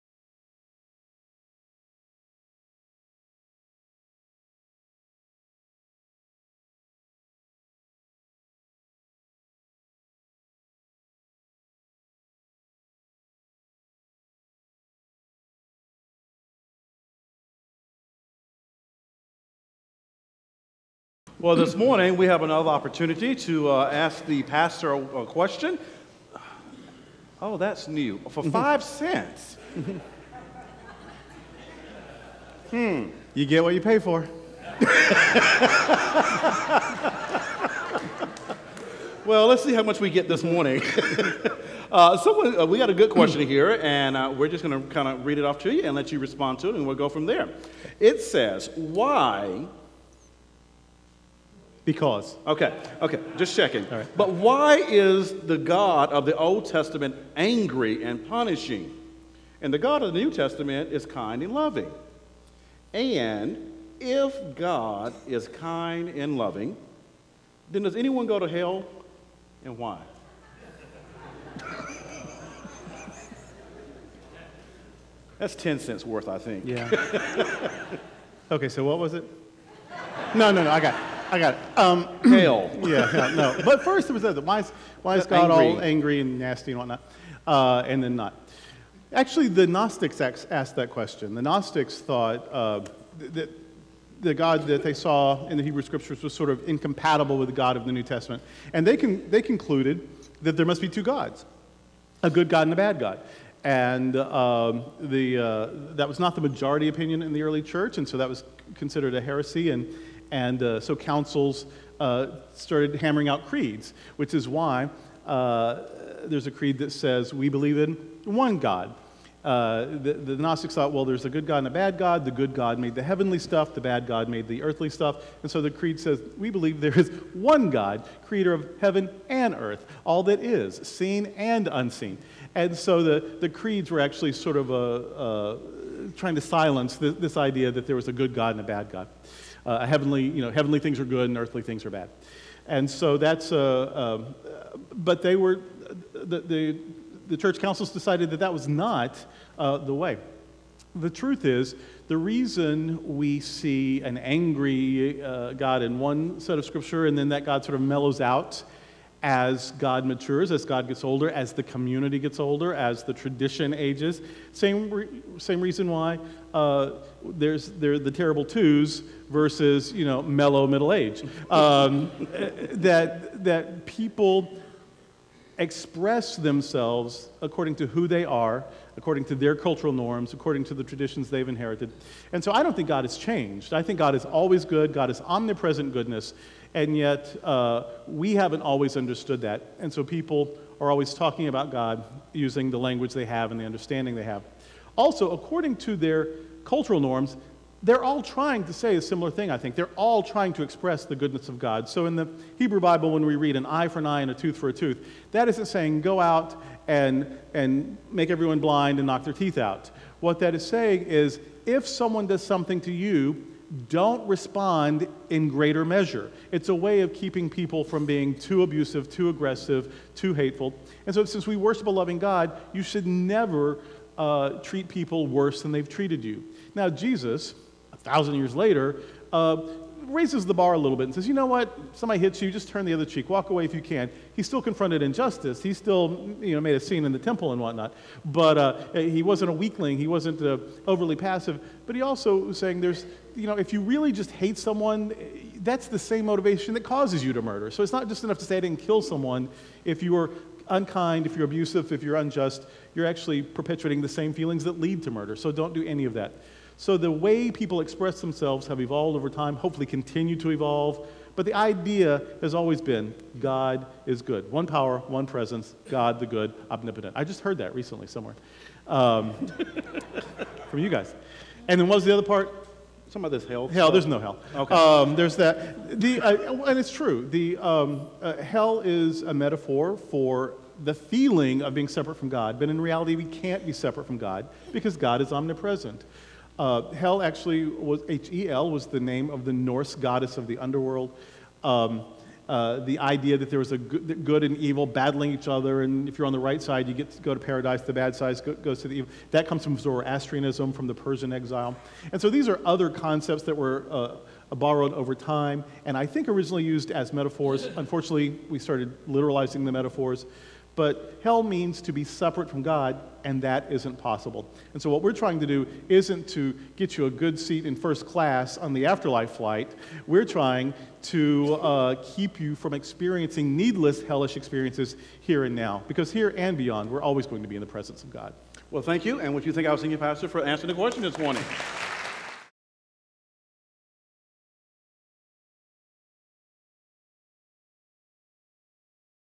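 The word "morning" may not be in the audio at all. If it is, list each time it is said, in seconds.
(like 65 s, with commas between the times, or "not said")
21 s, 40 s, 331 s.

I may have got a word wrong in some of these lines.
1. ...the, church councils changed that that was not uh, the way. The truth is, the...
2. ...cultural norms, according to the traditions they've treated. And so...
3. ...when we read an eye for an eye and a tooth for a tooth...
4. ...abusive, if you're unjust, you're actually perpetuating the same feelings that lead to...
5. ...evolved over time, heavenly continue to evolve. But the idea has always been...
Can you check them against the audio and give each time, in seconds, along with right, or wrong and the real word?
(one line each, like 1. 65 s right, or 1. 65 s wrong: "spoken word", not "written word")
1. 147 s wrong: "decided", not "changed"
2. 179 s wrong: "inherited", not "treated"
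3. 203 s right
4. 251 s right
5. 258 s wrong: "hopefully", not "heavenly".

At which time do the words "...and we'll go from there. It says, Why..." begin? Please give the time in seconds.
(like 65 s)
46 s.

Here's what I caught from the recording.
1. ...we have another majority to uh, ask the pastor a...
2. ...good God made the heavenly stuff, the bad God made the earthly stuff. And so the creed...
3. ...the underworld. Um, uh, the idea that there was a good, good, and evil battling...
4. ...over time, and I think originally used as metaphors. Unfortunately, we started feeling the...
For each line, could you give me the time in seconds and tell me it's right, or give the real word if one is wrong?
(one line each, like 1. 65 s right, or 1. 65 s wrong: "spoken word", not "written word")
1. 22 s wrong: "opportunity", not "majority"
2. 122 s right
3. 290 s right
4. 304 s wrong: "literalizing", not "feeling".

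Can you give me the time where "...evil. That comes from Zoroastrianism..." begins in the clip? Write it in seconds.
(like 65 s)
298 s.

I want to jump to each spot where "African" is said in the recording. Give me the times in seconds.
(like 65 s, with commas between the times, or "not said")
not said.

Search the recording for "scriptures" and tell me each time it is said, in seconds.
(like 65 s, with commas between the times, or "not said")
95 s, 156 s.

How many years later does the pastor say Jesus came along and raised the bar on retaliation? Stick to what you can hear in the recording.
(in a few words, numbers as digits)
1000.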